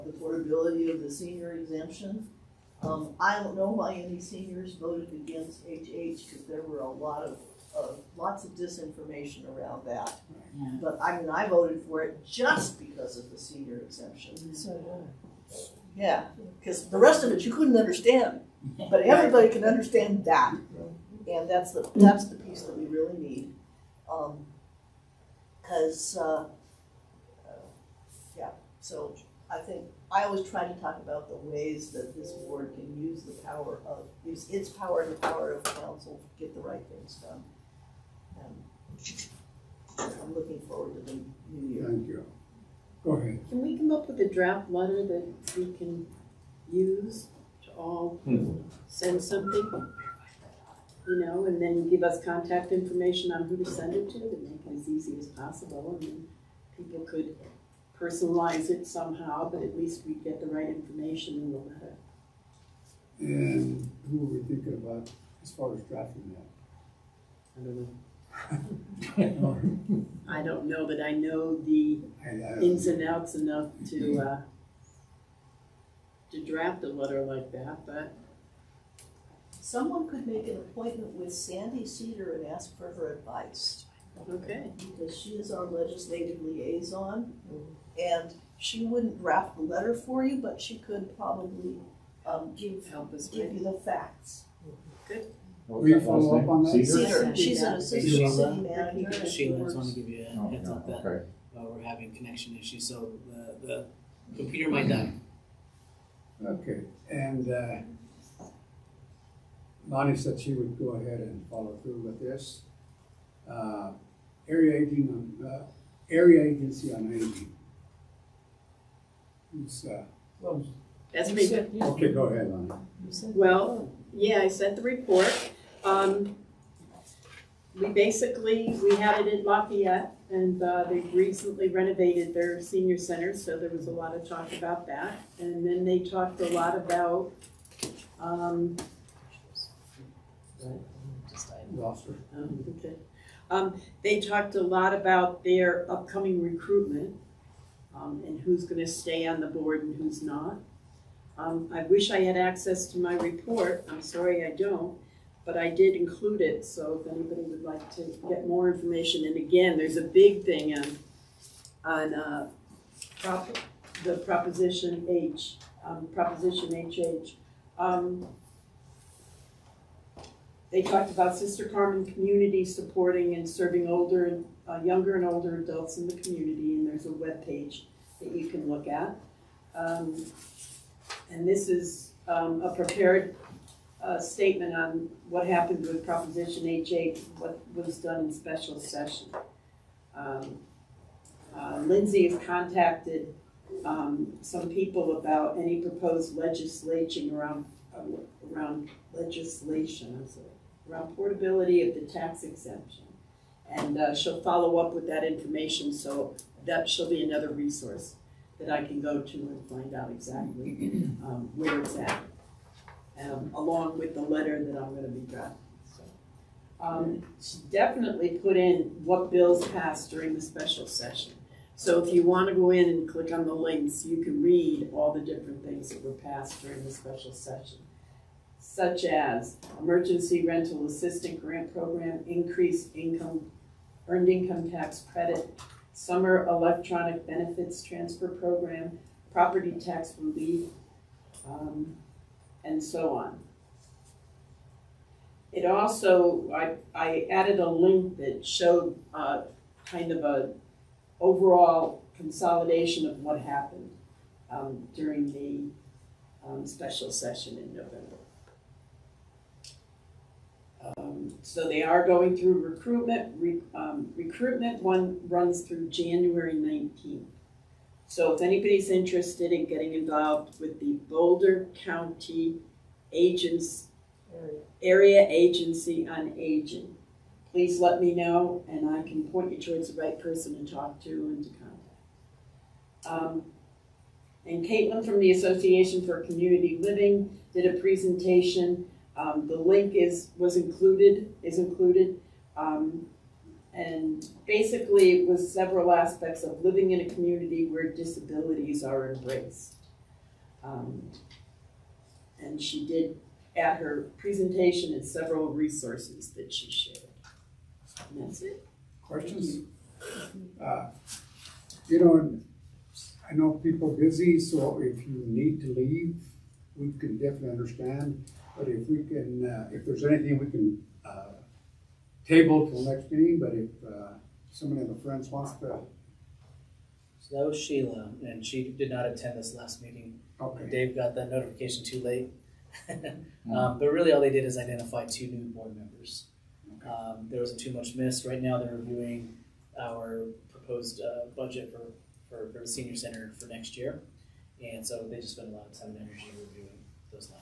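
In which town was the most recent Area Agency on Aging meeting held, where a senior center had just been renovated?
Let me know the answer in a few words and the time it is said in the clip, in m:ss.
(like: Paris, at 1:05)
Lafayette, at 2:09.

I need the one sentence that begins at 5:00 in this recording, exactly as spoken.
Um, and she did at her presentation and several resources that she shared.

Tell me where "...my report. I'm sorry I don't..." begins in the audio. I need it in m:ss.
2:32.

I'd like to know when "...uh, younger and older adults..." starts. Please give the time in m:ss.
2:54.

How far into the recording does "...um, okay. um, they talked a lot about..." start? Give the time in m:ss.
2:20.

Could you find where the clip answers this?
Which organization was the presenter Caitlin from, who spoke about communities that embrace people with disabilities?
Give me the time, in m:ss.
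4:45.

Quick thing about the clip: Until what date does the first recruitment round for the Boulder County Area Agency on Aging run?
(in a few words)
January 19th.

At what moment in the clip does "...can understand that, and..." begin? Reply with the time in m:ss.
0:19.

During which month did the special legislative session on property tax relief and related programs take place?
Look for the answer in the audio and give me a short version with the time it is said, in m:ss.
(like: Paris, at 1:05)
November, at 4:17.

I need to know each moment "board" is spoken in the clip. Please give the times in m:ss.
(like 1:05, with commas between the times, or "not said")
0:32, 2:29, 5:35.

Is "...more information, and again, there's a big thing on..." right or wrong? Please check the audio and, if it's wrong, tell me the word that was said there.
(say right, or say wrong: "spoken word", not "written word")
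right.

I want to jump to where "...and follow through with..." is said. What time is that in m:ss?
1:51.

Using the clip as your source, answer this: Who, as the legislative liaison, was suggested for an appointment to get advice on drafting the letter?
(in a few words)
Sandi Seader.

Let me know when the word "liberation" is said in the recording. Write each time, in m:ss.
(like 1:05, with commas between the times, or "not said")
not said.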